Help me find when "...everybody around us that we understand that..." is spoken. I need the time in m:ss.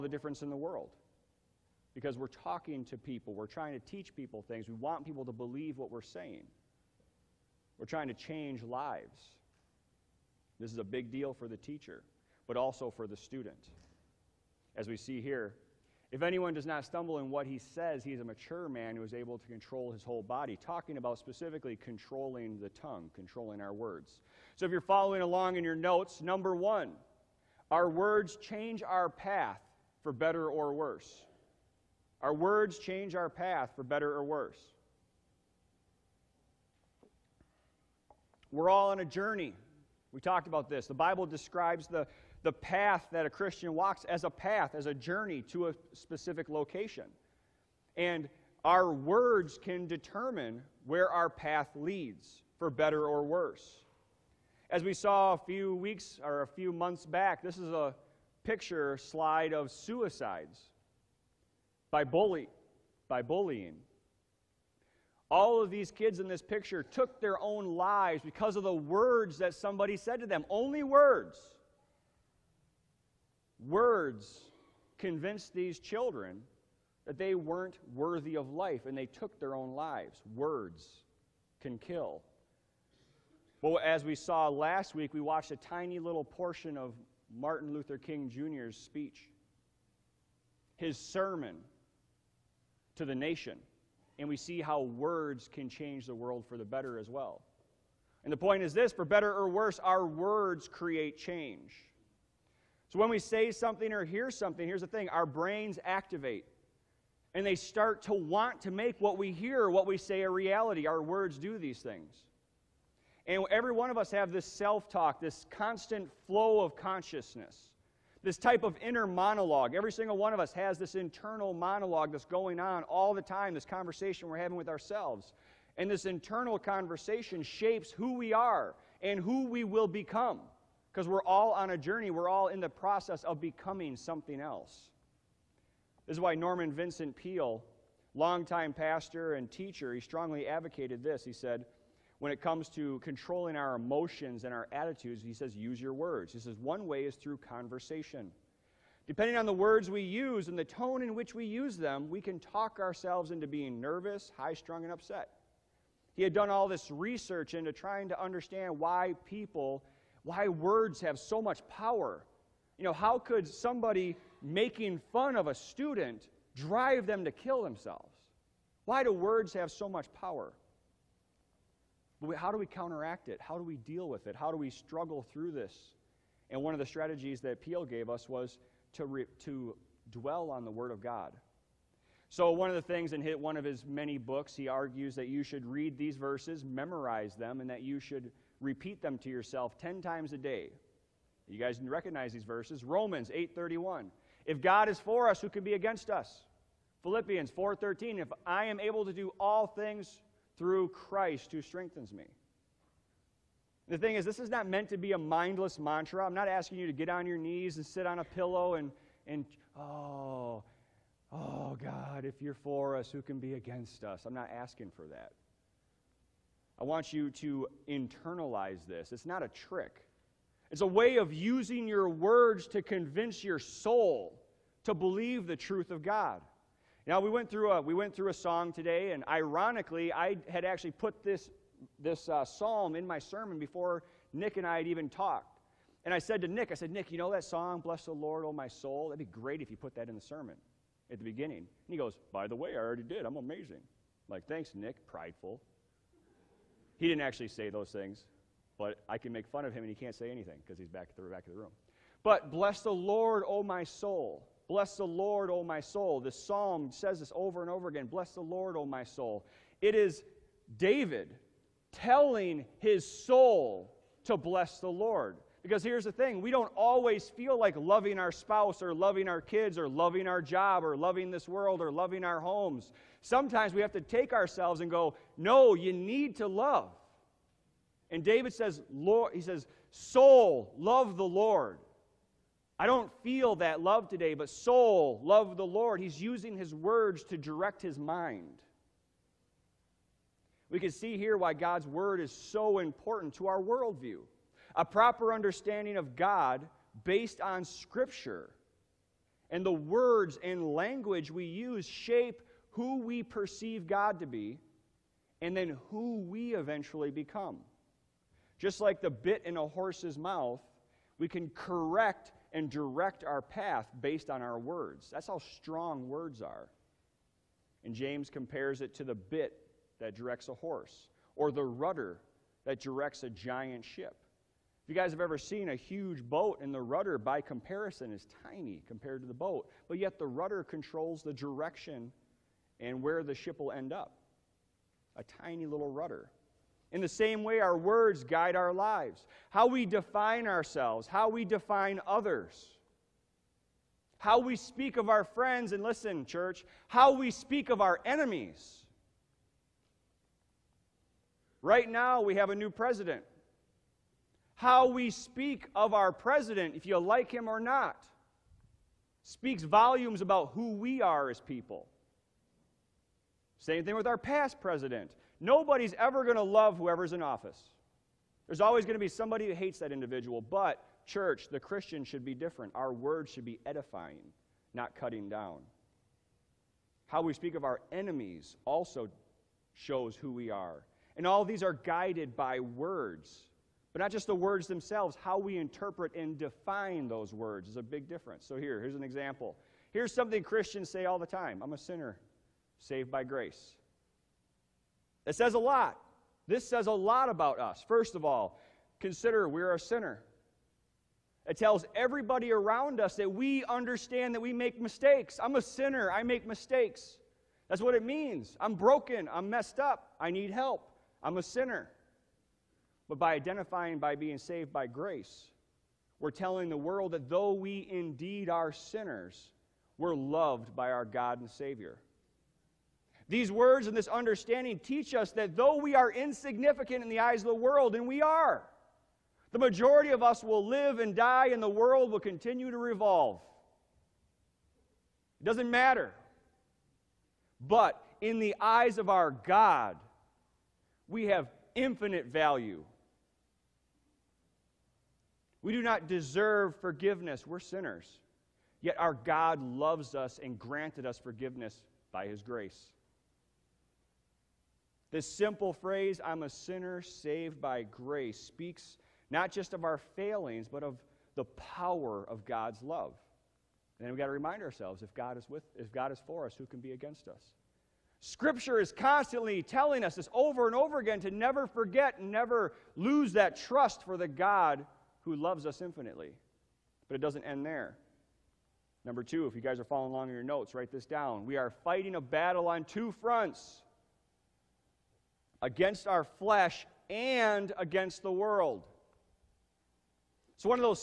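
6:41.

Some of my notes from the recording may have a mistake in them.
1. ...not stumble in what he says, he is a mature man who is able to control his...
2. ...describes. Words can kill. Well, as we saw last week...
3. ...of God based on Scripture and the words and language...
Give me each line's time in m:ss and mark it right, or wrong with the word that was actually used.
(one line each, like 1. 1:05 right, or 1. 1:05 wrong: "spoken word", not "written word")
1. 0:16 right
2. 1:19 wrong: "lives", not "describes"
3. 4:55 right.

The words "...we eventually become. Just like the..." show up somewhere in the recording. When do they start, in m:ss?
5:06.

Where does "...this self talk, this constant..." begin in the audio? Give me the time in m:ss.
1:54.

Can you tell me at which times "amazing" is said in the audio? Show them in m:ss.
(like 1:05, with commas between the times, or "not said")
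4:03.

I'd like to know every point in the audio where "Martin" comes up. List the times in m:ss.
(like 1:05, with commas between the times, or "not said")
1:27.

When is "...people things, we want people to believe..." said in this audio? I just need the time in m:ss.
0:04.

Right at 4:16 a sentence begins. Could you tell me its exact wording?
This psalm says this over and over again.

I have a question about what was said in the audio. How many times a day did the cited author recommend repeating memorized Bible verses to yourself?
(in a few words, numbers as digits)
10.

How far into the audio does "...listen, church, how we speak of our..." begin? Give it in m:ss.
5:45.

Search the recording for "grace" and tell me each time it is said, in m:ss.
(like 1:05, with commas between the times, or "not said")
6:33, 6:54, 7:32, 7:37.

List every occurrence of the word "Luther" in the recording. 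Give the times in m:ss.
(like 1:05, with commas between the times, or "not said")
1:27.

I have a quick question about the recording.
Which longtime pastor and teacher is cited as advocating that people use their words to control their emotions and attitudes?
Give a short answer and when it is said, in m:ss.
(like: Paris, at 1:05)
Norman Vincent Peale, at 2:16.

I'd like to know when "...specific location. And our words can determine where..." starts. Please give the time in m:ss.
0:45.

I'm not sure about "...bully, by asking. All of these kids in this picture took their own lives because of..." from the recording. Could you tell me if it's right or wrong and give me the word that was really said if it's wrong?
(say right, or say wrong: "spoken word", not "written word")
wrong: "bullying", not "asking".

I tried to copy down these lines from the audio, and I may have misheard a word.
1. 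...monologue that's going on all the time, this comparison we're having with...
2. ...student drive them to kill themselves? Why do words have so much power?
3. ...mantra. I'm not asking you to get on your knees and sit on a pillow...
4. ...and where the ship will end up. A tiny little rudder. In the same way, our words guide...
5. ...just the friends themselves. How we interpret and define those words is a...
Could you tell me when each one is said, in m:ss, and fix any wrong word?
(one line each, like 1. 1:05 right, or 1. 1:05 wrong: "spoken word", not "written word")
1. 2:01 wrong: "conversation", not "comparison"
2. 2:45 right
3. 3:25 right
4. 5:32 right
5. 6:24 wrong: "words", not "friends".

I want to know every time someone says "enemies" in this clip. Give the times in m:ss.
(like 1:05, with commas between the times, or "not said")
5:48, 6:17.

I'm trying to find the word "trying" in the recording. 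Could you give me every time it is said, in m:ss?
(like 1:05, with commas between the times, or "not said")
0:03, 0:07, 2:37.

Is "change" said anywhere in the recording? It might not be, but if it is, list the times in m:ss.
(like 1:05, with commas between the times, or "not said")
0:08, 0:28, 0:32, 1:35, 1:41.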